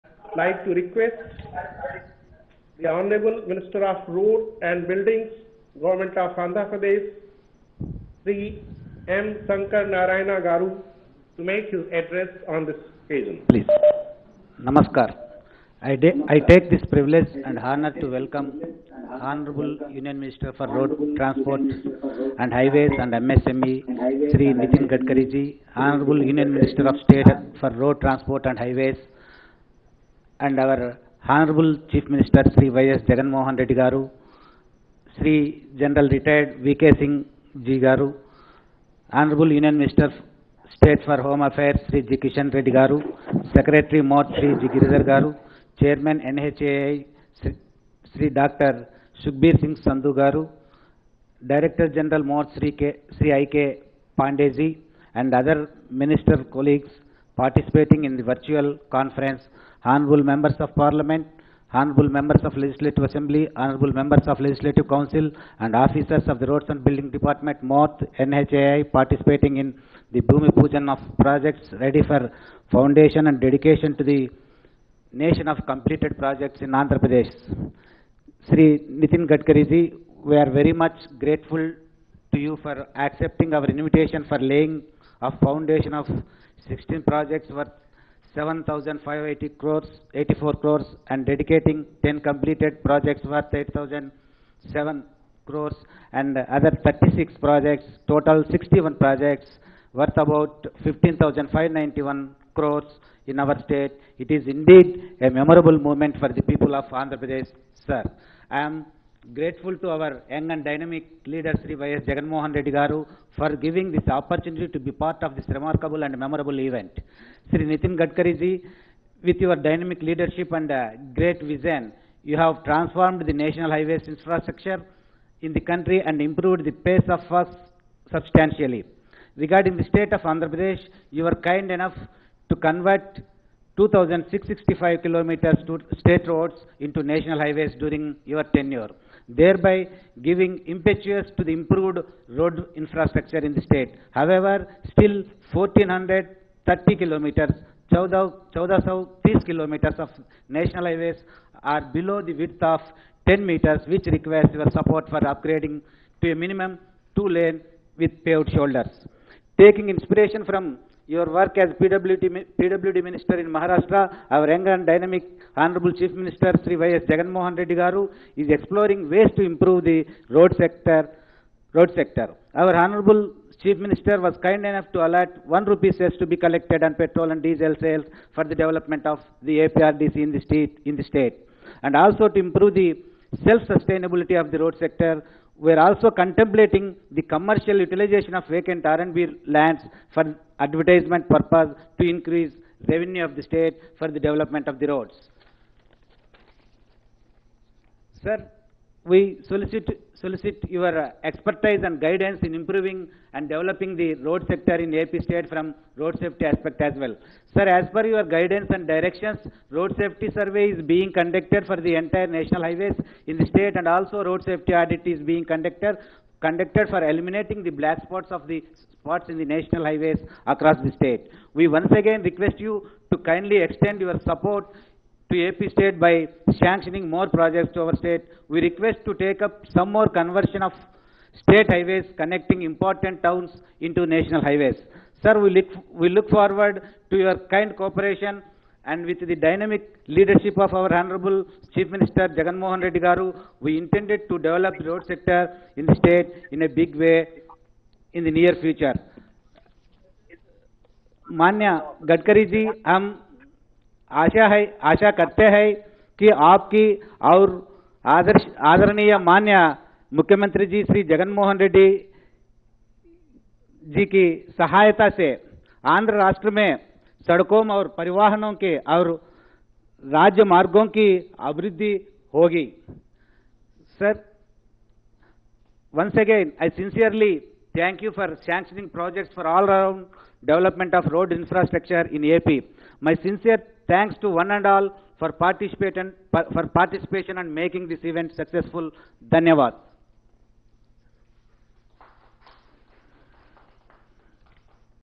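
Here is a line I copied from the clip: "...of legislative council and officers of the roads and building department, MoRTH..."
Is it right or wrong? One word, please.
right.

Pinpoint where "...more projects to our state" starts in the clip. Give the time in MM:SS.
03:47.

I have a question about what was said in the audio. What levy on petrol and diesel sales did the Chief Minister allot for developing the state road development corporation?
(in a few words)
1 rupee cess.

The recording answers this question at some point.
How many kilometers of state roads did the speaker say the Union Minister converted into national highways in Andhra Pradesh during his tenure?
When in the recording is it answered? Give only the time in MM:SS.
02:13.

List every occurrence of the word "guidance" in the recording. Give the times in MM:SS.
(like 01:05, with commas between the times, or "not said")
03:21, 03:28.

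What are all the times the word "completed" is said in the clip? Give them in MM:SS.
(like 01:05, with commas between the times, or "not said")
01:15, 01:32.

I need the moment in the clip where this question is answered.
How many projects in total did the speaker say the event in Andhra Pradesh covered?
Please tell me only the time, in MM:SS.
01:38.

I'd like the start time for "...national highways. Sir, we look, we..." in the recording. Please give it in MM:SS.
03:54.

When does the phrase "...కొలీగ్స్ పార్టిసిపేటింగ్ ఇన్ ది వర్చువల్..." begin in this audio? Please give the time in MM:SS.
00:56.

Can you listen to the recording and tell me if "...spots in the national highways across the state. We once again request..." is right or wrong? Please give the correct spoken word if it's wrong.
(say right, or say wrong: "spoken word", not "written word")
right.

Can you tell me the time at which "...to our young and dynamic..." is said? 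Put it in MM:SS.
01:49.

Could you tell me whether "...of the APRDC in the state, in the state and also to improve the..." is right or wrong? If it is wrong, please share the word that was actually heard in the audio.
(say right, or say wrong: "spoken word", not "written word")
right.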